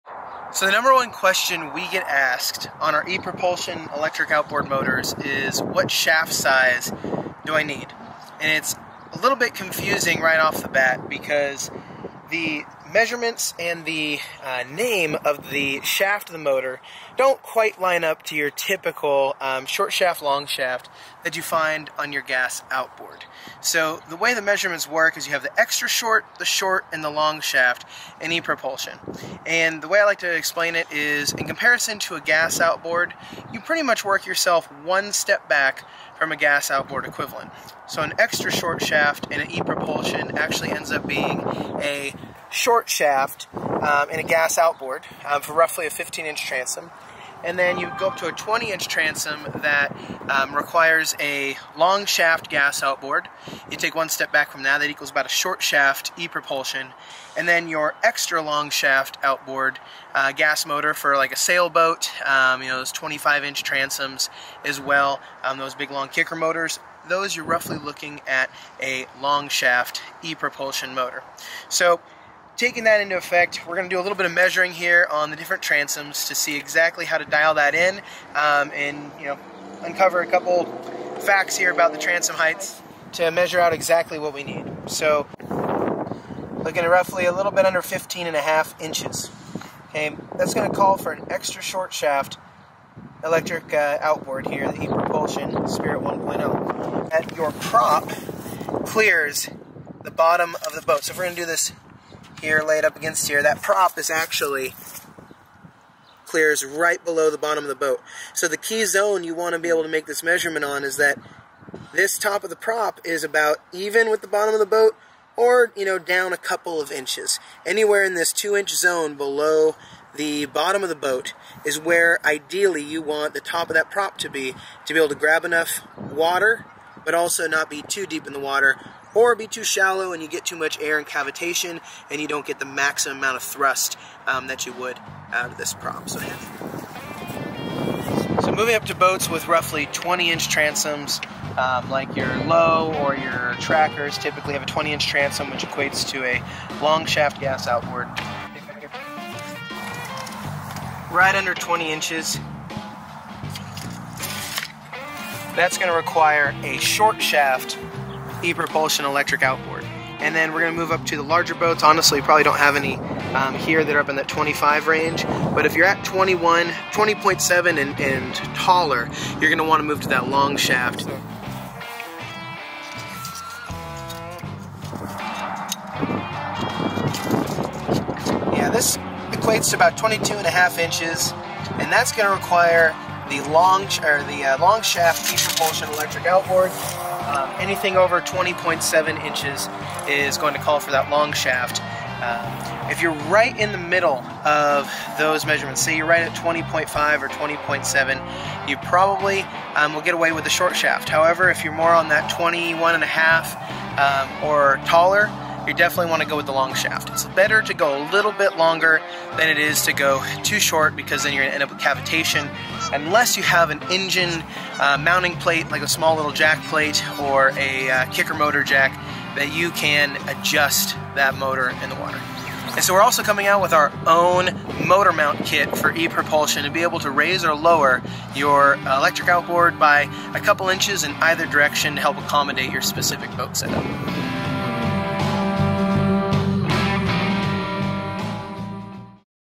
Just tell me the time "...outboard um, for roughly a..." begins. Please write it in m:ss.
0:44.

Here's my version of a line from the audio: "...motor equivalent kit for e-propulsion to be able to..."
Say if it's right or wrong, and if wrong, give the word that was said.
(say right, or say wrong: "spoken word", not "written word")
wrong: "mount", not "equivalent".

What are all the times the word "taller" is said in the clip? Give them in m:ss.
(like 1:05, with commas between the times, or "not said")
2:48, 3:24.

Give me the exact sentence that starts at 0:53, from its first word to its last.
You take one step back from that, that equals about a short shaft e propulsion.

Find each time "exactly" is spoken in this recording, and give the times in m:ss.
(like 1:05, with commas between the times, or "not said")
1:16, 1:23.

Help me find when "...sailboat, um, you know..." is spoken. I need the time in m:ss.
1:01.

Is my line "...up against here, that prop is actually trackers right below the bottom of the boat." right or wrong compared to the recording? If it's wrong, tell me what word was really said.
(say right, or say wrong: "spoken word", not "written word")
wrong: "clears", not "trackers".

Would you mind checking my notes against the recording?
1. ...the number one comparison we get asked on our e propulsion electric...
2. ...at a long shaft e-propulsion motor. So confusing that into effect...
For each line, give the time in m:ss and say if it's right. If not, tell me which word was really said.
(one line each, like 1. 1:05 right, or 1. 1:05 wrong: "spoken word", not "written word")
1. 0:00 wrong: "question", not "comparison"
2. 1:08 wrong: "taking", not "confusing".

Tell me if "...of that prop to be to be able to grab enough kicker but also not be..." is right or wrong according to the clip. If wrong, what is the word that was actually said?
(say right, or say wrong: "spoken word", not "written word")
wrong: "water", not "kicker".